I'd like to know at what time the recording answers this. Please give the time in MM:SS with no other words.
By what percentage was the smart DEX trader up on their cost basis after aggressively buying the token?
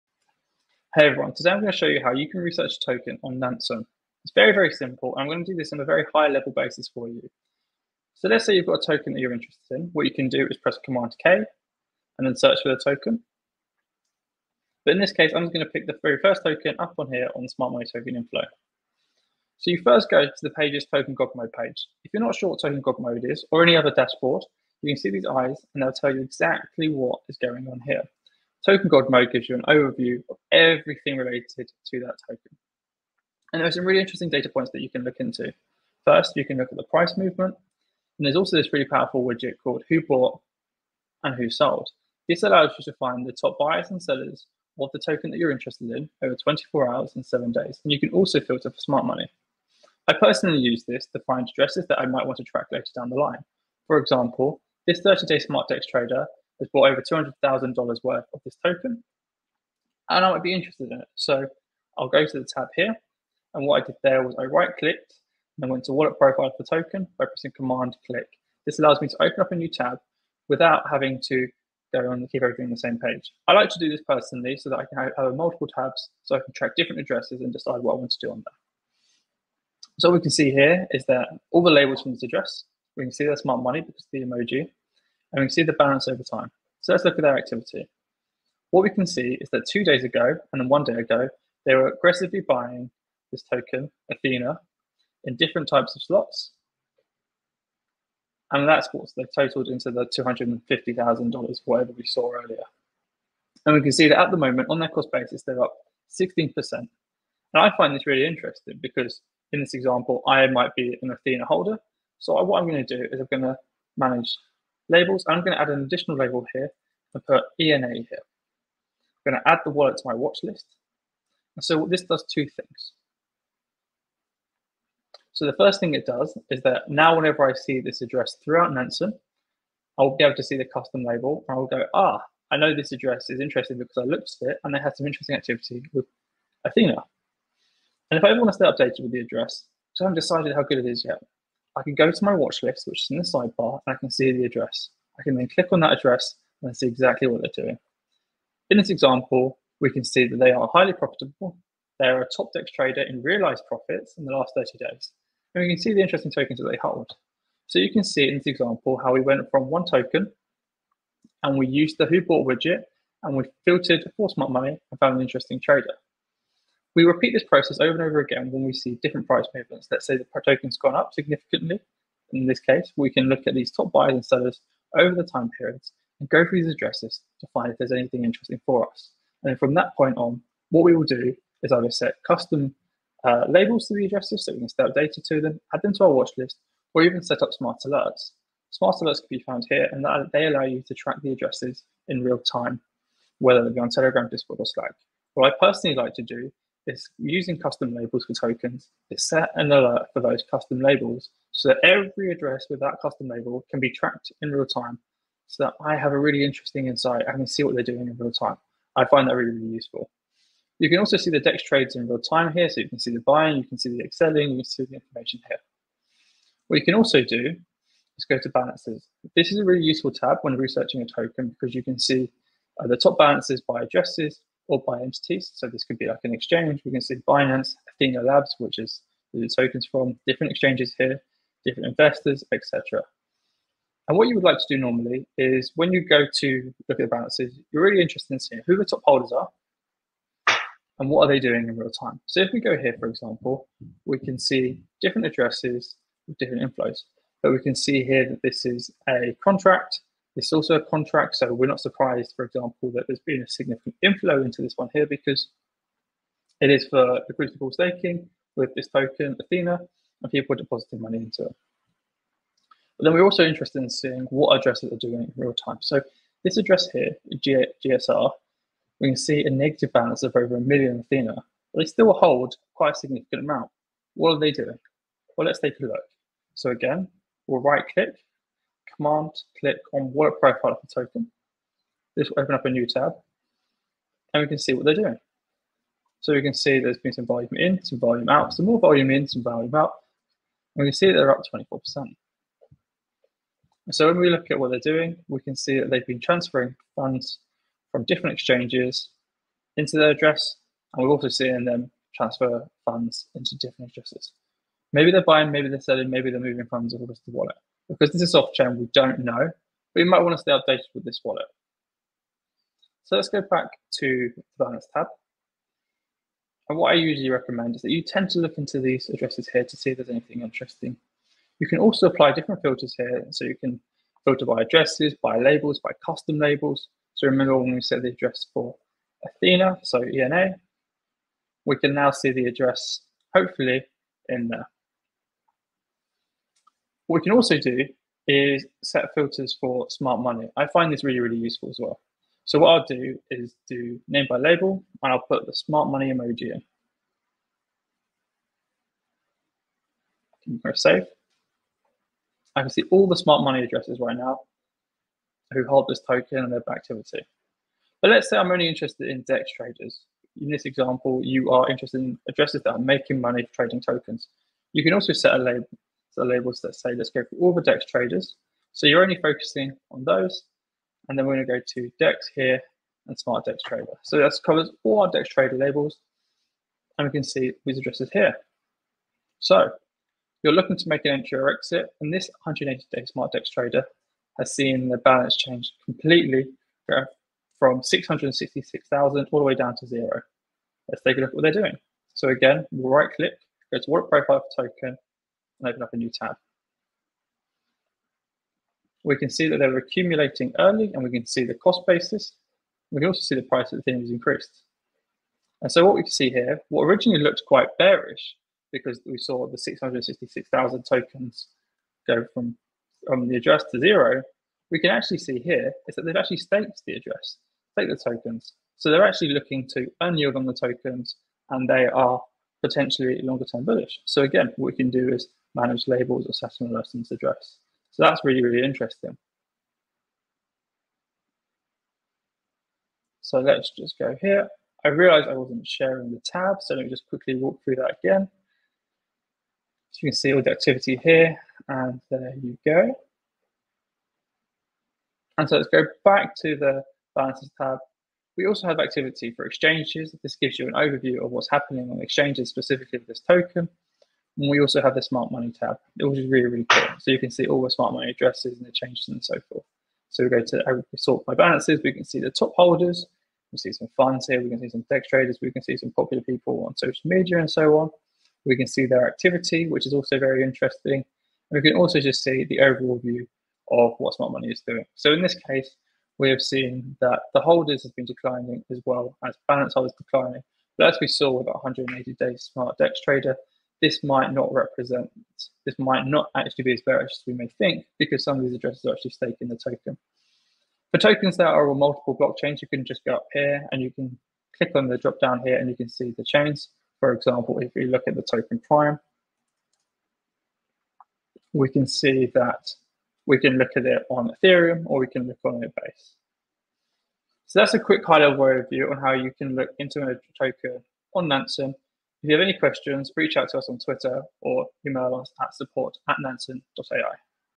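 01:46.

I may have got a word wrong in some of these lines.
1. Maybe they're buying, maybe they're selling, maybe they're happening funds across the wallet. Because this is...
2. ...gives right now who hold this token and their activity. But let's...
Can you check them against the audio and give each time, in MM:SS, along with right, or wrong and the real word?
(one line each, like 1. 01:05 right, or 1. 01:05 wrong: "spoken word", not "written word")
1. 05:04 wrong: "moving", not "happening"
2. 05:53 wrong: "addresses", not "gives".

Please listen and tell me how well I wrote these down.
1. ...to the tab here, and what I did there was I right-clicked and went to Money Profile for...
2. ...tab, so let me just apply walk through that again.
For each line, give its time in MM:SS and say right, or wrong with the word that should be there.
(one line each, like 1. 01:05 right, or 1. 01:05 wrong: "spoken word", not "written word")
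1. 01:02 wrong: "Wallet", not "Money"
2. 07:16 wrong: "quickly", not "apply".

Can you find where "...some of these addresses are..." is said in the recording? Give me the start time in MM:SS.
08:08.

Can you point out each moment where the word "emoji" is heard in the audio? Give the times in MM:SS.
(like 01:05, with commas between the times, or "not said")
01:24, 05:46.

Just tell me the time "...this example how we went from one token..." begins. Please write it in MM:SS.
02:38.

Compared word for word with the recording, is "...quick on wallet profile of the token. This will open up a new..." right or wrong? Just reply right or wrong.
wrong.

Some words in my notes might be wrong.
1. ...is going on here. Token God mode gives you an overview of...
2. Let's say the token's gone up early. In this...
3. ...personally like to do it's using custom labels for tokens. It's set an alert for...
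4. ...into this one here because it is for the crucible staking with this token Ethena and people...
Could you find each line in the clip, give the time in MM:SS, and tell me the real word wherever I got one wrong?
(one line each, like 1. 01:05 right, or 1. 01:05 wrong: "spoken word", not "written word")
1. 00:27 right
2. 02:49 wrong: "significantly", not "early"
3. 03:15 right
4. 04:14 right.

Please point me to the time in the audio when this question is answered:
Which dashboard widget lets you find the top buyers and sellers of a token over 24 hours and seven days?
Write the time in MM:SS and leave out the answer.
00:39.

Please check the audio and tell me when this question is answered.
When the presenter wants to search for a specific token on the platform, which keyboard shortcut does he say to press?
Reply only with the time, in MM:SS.
00:10.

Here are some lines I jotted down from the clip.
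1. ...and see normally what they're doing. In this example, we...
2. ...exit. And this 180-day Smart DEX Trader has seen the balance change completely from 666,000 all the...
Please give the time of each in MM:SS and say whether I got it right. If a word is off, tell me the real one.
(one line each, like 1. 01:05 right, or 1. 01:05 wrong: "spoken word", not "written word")
1. 02:26 wrong: "exactly", not "normally"
2. 06:21 right.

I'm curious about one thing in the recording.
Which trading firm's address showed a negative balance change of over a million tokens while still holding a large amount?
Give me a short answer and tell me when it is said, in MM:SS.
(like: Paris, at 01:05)
GSR, at 04:27.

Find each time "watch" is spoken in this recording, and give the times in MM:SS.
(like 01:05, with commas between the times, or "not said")
02:00, 02:22, 03:06.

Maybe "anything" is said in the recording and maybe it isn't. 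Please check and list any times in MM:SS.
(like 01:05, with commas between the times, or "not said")
02:57, 05:20.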